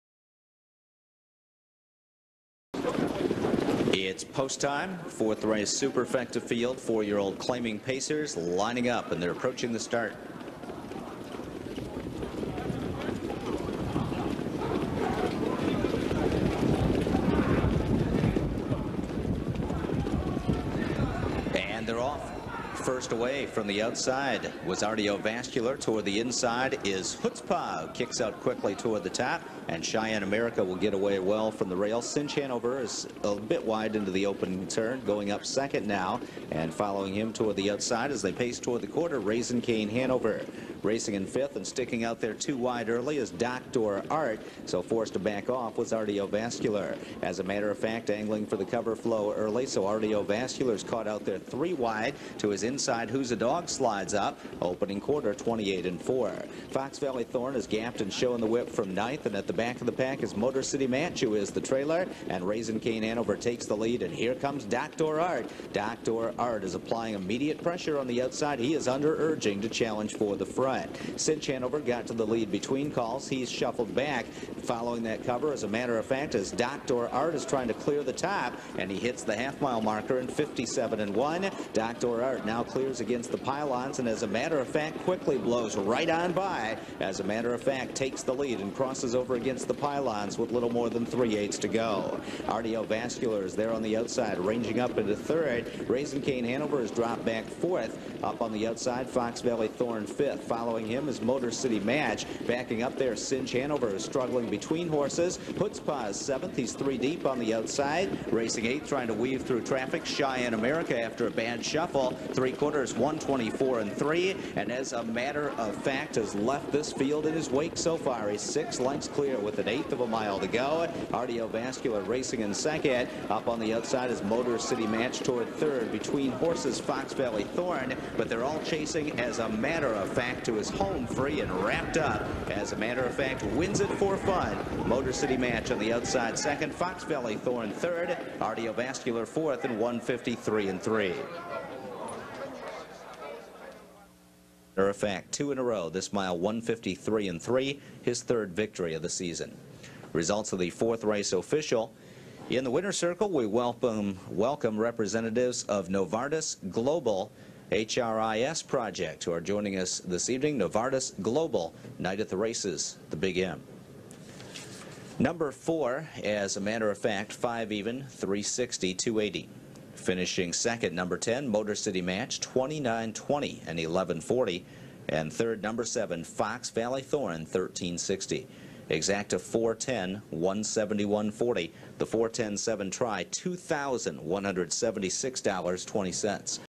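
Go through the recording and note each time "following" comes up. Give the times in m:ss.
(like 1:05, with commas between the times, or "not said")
0:36, 1:14, 1:40.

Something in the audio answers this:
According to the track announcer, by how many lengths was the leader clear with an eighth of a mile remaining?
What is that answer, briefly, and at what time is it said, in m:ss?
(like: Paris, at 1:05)
6, at 1:58.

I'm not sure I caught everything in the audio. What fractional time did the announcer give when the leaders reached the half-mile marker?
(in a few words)
57 and 1.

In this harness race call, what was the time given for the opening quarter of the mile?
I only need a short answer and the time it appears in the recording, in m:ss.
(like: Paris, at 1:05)
28 and 4, at 0:55.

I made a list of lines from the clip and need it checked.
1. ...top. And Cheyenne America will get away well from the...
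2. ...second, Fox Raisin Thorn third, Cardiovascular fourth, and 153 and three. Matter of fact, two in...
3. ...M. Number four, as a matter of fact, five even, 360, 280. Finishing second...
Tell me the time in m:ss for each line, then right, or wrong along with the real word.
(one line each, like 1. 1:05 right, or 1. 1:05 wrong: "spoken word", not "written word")
1. 0:29 right
2. 2:16 wrong: "Valley", not "Raisin"
3. 2:43 right.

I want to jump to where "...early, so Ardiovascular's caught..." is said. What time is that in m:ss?
0:49.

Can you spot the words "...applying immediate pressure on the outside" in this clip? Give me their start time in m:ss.
1:06.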